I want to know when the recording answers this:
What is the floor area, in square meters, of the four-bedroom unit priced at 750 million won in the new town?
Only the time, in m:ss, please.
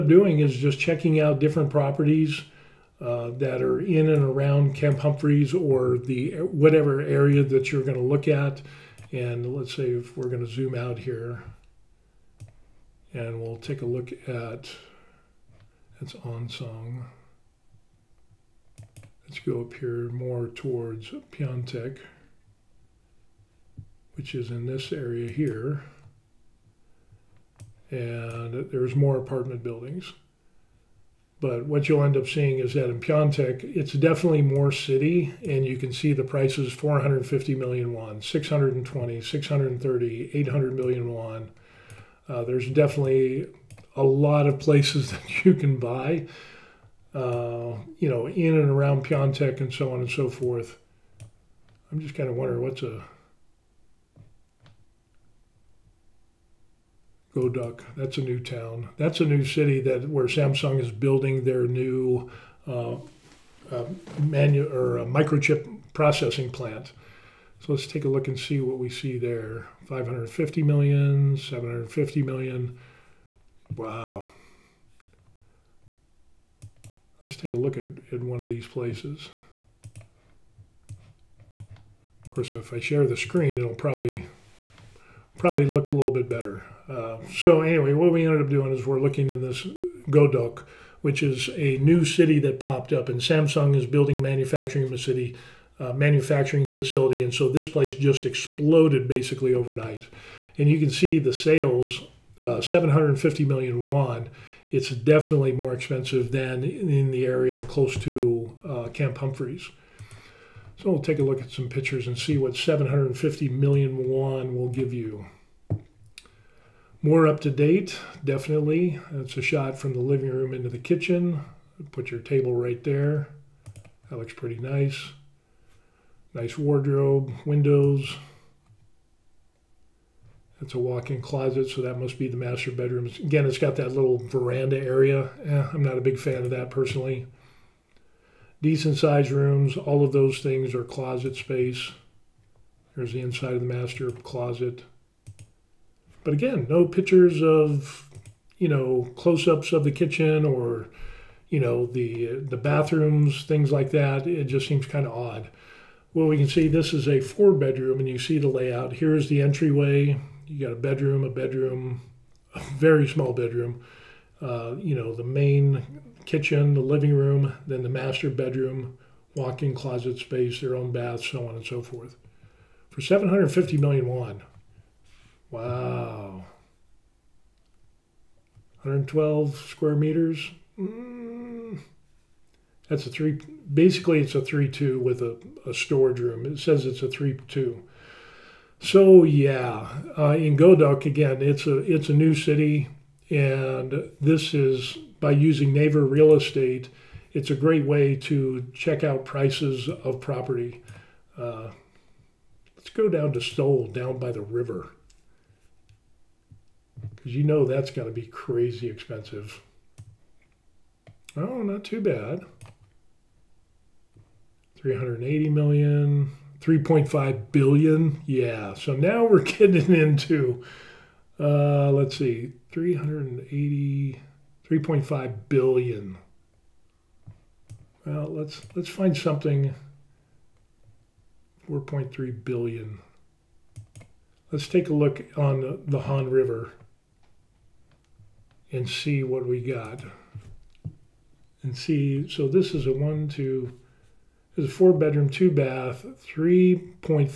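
2:58.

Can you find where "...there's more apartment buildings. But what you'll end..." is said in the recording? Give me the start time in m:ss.
0:28.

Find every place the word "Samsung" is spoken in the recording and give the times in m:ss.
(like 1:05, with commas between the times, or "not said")
1:00, 1:33.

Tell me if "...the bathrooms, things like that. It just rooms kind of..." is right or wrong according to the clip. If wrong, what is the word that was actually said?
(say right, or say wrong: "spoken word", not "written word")
wrong: "seems", not "rooms".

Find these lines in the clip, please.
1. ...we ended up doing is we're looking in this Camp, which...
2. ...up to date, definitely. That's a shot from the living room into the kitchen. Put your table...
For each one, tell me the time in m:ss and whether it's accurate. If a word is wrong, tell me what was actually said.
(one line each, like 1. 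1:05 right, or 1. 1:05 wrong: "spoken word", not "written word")
1. 1:28 wrong: "Godeok", not "Camp"
2. 1:57 right.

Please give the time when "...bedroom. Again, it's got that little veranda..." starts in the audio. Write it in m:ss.
2:12.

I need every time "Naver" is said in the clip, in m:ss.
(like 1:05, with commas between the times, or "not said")
3:15.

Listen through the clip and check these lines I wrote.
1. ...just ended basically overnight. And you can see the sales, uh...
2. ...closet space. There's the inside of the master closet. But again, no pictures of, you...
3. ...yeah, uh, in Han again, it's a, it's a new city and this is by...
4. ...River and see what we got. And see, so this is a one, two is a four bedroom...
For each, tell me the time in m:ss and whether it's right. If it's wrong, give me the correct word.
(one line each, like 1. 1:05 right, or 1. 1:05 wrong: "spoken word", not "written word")
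1. 1:37 wrong: "exploded", not "ended"
2. 2:20 right
3. 3:09 wrong: "Godeok", not "Han"
4. 3:56 right.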